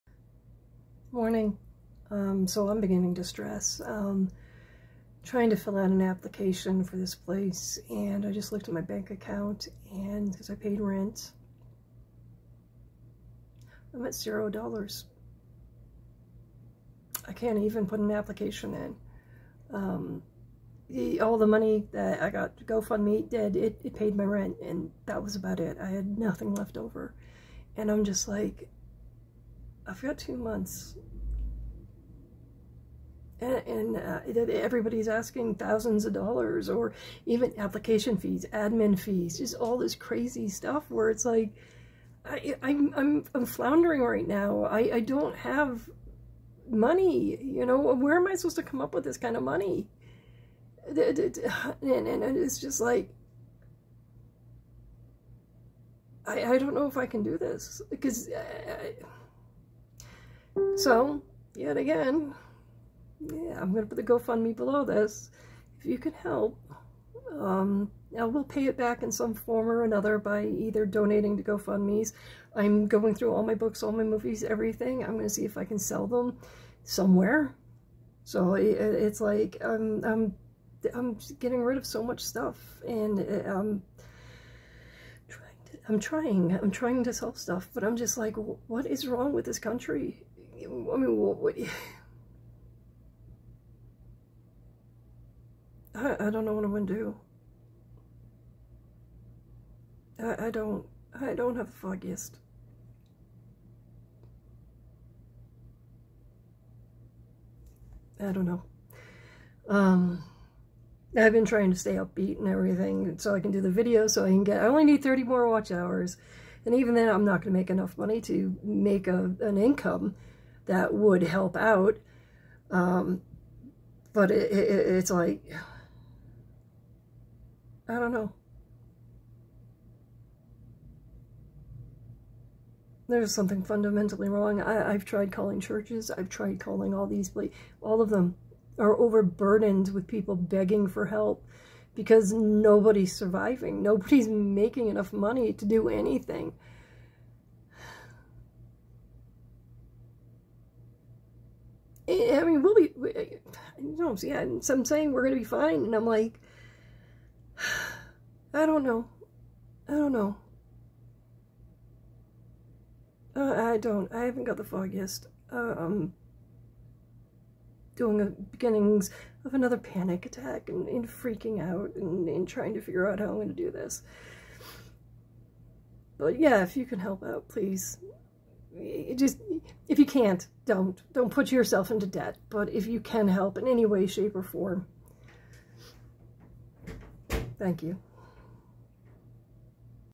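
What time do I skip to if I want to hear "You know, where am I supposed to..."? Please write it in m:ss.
0:47.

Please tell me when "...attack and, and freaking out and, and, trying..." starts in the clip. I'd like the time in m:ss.
2:50.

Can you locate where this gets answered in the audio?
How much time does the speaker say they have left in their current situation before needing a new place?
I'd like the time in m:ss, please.
0:30.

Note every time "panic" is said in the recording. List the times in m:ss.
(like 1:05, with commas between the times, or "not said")
2:49.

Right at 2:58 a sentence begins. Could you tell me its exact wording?
It just if you can't, don't.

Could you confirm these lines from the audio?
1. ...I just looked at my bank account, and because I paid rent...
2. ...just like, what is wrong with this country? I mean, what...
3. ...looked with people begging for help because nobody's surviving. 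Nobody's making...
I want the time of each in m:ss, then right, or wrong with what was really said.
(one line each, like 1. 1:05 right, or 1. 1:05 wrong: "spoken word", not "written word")
1. 0:08 right
2. 1:27 right
3. 2:18 wrong: "overburdened", not "looked".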